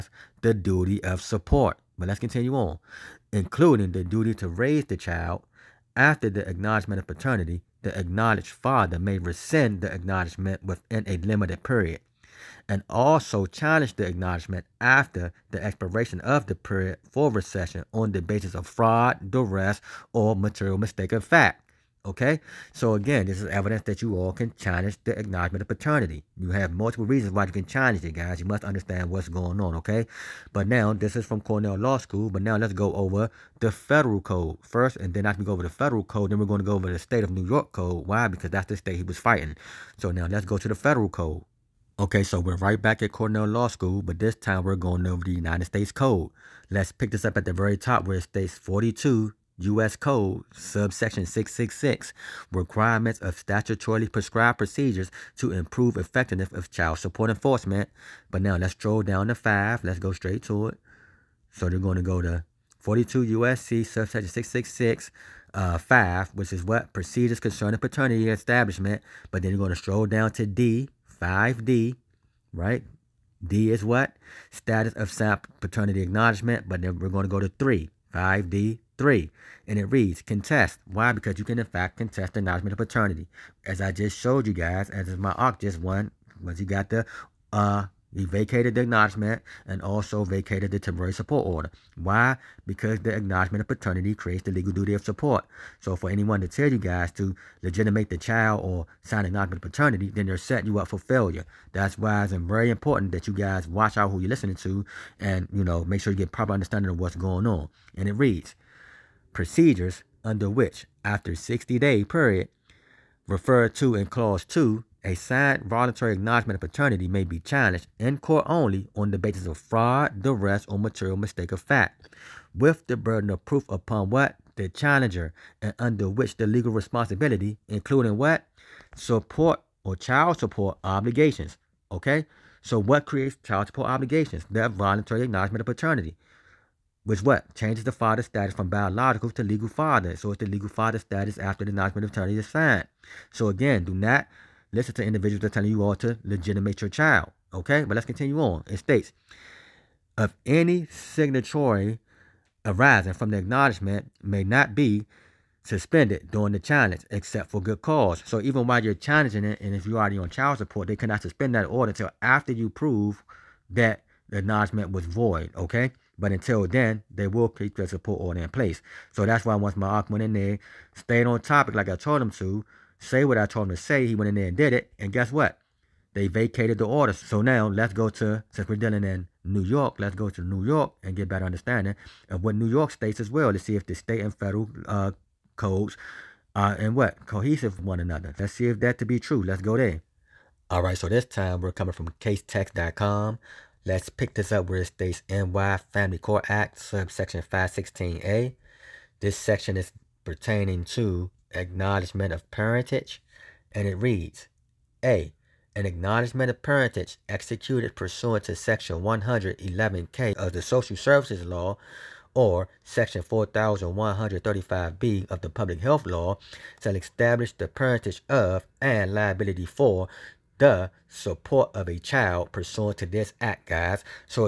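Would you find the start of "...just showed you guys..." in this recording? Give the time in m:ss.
1:23.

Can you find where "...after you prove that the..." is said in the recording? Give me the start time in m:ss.
2:42.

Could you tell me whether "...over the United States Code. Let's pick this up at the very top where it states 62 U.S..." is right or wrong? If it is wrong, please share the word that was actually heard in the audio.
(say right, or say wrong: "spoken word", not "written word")
wrong: "42", not "62".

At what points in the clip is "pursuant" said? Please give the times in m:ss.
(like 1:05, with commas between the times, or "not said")
3:27, 3:42.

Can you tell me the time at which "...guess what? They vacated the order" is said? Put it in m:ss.
2:55.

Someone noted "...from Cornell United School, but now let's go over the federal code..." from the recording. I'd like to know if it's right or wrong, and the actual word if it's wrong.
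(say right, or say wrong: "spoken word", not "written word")
wrong: "Law", not "United".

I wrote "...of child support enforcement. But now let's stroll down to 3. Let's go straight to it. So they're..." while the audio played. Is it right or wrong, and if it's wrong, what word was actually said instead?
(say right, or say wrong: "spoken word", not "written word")
wrong: "5", not "3".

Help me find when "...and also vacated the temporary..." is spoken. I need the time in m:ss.
1:29.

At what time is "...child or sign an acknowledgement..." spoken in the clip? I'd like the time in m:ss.
1:38.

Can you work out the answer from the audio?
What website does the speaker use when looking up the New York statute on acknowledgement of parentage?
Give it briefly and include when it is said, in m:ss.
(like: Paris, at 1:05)
casetext.com, at 3:12.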